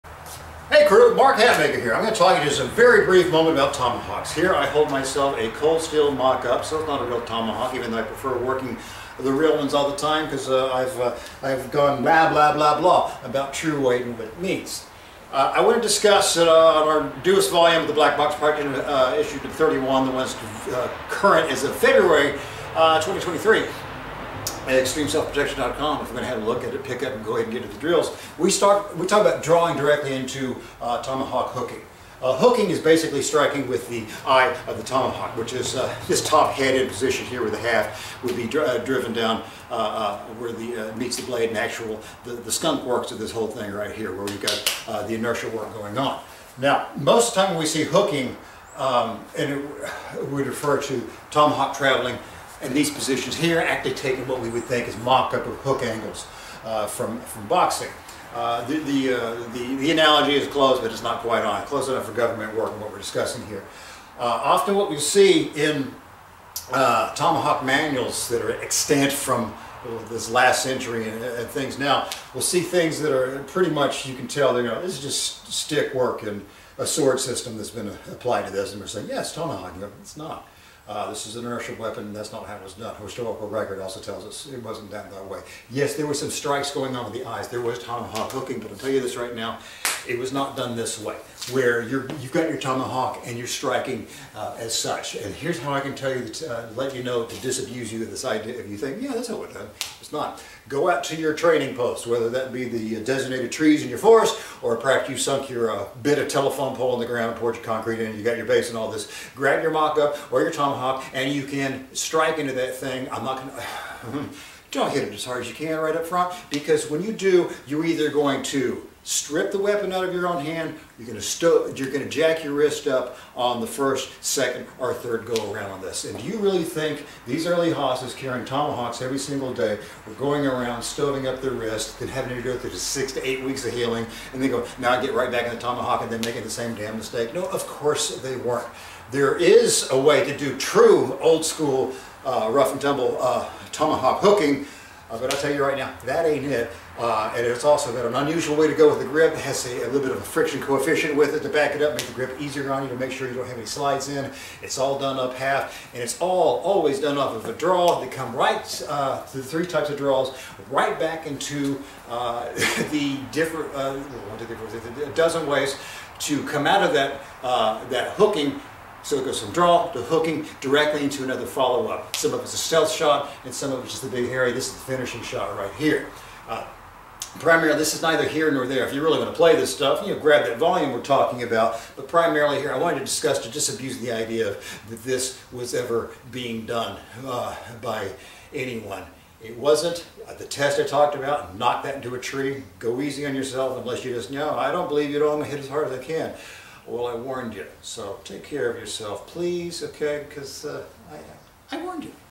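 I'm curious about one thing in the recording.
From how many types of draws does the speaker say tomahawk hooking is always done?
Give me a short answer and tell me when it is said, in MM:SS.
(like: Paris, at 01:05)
3, at 02:39.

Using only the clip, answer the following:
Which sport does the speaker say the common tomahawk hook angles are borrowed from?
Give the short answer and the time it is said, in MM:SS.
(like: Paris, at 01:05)
Boxing, at 00:57.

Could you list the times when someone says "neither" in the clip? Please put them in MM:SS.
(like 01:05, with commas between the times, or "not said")
02:58.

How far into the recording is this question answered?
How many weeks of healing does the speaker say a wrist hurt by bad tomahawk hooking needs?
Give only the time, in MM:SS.
02:12.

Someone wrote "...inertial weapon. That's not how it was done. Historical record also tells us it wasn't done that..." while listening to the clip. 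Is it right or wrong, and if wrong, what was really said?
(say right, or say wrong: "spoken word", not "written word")
right.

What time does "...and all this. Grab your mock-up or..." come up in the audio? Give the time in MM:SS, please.
01:48.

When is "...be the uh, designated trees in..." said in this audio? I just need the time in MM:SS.
01:42.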